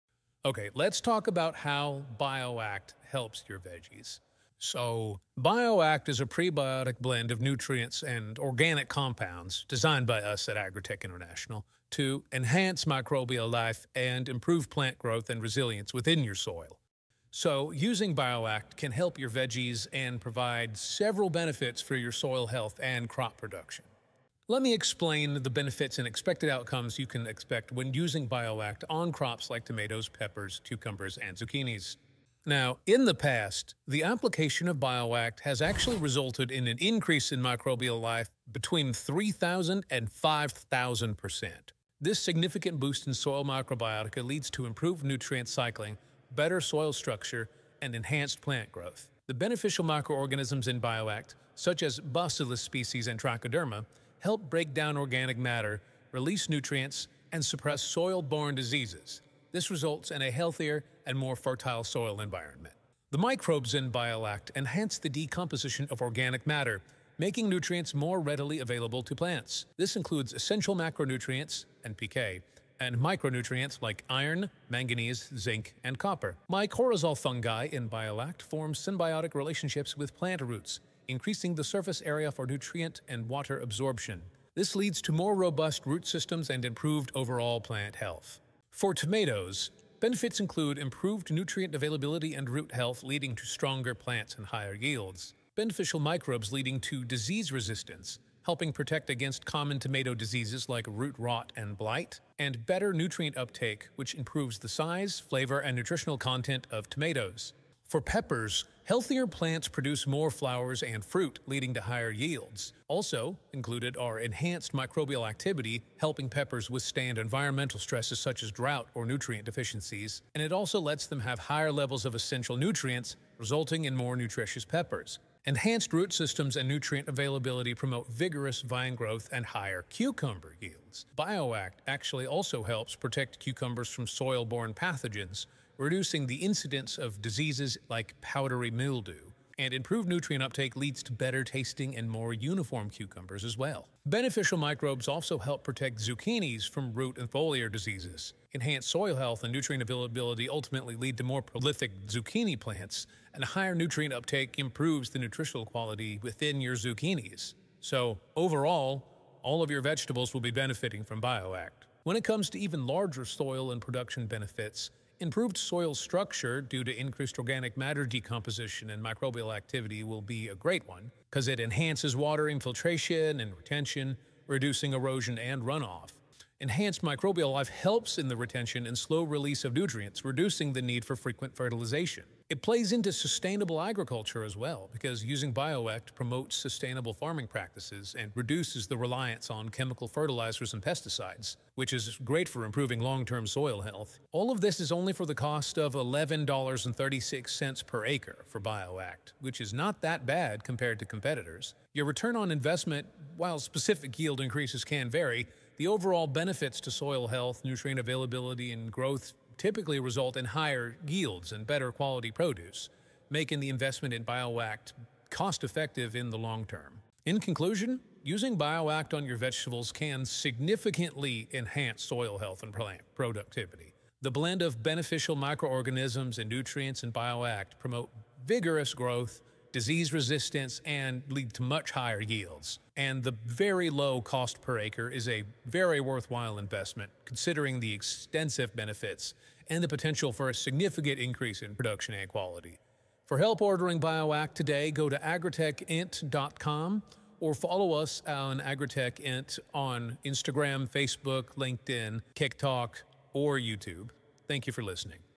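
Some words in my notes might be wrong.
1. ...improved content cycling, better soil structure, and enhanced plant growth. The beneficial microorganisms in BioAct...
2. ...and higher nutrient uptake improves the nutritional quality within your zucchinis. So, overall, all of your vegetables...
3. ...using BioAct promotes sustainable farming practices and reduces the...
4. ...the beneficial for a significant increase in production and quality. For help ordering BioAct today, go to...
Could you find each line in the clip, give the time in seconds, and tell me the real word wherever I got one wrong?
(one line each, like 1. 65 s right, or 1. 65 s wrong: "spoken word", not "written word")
1. 44 s wrong: "nutrient", not "content"
2. 153 s right
3. 185 s right
4. 239 s wrong: "potential", not "beneficial".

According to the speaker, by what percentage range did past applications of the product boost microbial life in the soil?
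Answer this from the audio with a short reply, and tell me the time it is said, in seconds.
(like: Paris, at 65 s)
3,000 to 5,000%, at 38 s.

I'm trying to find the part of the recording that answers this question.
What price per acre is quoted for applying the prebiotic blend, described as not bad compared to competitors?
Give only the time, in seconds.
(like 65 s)
195 s.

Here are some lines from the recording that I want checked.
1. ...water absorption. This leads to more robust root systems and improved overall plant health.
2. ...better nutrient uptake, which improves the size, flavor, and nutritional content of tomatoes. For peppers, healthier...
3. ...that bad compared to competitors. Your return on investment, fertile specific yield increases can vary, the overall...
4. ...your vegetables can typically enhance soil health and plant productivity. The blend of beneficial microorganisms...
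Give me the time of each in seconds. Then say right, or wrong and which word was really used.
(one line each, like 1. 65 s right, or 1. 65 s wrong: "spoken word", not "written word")
1. 83 s right
2. 102 s right
3. 200 s wrong: "while", not "fertile"
4. 219 s wrong: "significantly", not "typically".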